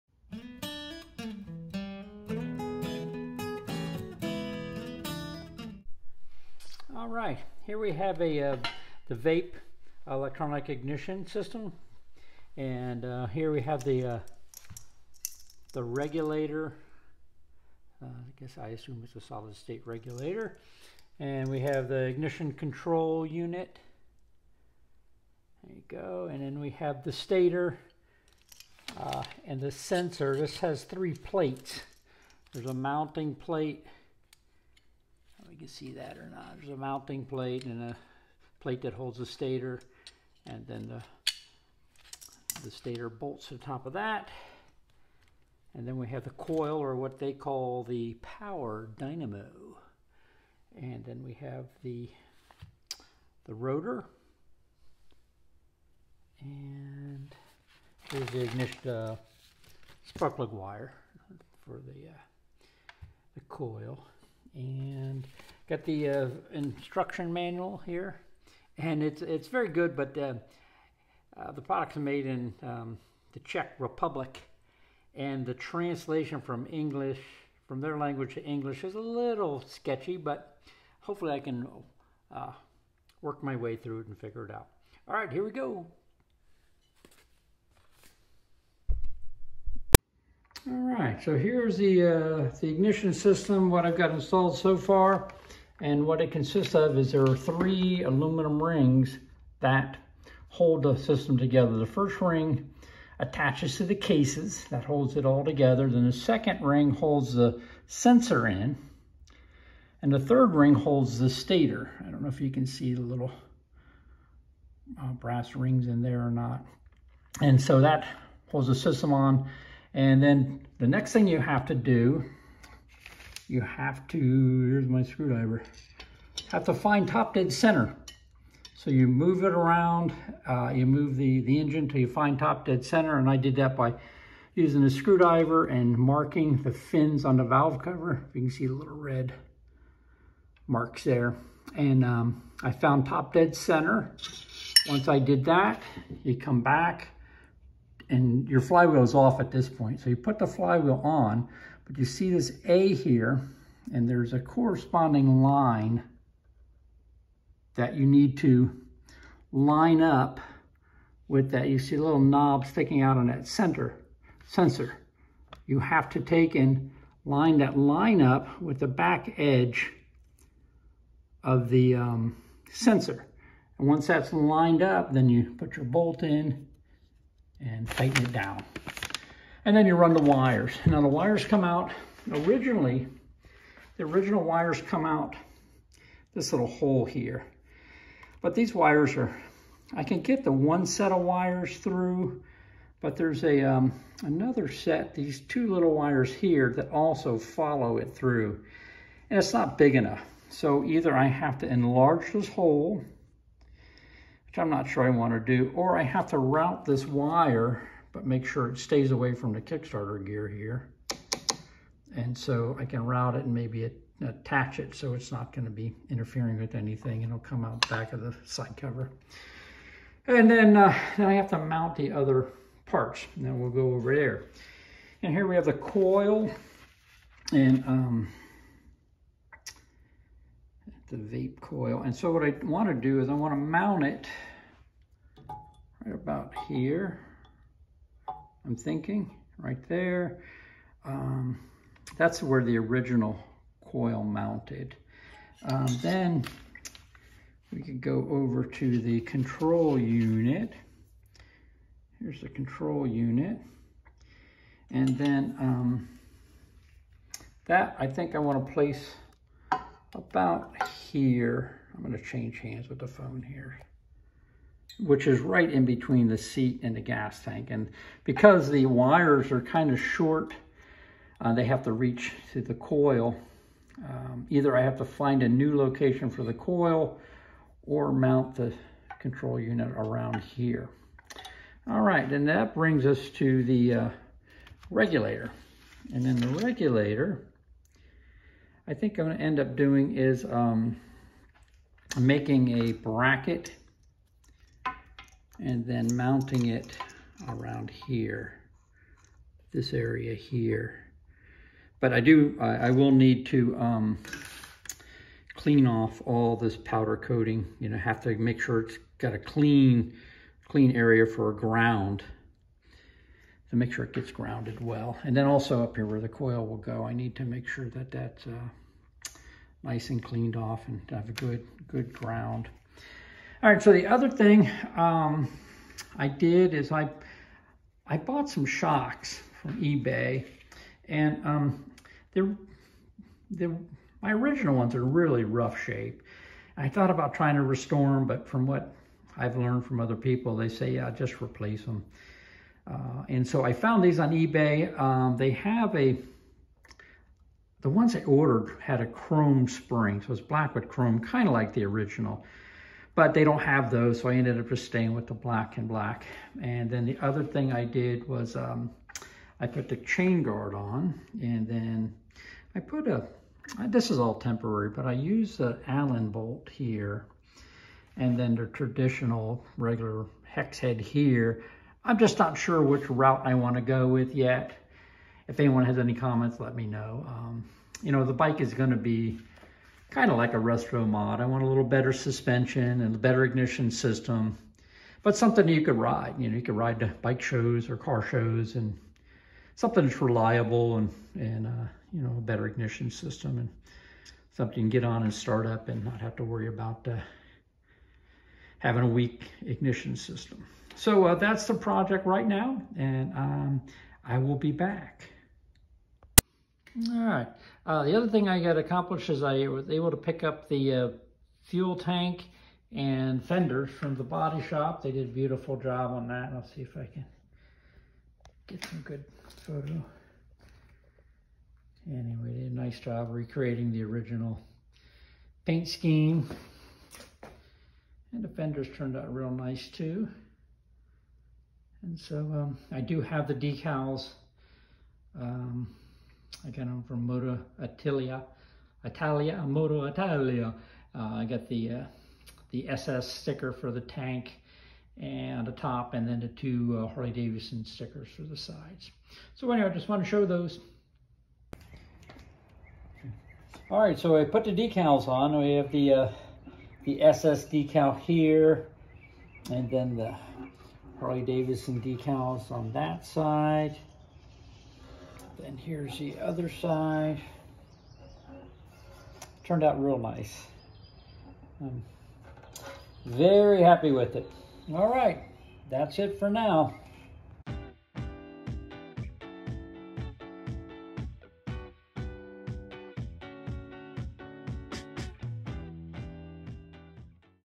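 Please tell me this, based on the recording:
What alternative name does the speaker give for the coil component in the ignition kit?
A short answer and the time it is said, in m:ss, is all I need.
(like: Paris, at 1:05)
power dynamo, at 0:48.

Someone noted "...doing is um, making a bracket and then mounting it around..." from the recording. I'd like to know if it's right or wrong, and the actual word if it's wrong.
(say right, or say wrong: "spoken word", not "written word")
right.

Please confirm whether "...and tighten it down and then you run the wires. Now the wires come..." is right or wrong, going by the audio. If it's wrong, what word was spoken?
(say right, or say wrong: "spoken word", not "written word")
right.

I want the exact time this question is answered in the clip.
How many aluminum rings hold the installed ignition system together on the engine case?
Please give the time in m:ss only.
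1:37.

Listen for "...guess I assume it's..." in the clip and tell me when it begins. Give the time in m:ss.
0:18.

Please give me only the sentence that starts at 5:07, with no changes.
You know, have to make sure it's got a clean, clean area for a ground to make sure it gets grounded well.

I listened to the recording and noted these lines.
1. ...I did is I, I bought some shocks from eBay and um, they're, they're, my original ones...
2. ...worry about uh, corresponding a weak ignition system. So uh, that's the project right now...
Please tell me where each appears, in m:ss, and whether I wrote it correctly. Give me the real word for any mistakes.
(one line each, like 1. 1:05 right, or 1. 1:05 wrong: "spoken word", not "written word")
1. 5:26 right
2. 6:36 wrong: "having", not "corresponding".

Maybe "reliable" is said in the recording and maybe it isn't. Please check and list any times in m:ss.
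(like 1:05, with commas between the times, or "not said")
6:30.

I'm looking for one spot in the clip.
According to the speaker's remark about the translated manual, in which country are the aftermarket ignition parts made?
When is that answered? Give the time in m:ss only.
1:13.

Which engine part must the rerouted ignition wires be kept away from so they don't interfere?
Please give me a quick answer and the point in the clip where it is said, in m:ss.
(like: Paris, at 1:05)
Kickstarter gear, at 3:29.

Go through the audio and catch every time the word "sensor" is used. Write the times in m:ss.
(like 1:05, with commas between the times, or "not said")
0:29, 1:47, 2:44, 2:52.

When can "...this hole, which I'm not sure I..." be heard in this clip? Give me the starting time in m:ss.
3:22.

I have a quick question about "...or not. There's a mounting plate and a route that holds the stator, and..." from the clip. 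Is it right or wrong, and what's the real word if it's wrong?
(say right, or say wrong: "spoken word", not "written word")
wrong: "plate", not "route".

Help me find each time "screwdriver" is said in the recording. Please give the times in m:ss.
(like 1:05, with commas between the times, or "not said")
2:05, 2:14.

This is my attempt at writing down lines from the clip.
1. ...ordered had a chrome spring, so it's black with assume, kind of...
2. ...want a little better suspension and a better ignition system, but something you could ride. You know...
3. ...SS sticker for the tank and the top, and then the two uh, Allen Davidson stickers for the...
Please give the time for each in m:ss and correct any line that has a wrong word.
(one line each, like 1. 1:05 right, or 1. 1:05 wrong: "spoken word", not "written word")
1. 5:48 wrong: "chrome", not "assume"
2. 6:21 right
3. 7:22 wrong: "Harley", not "Allen".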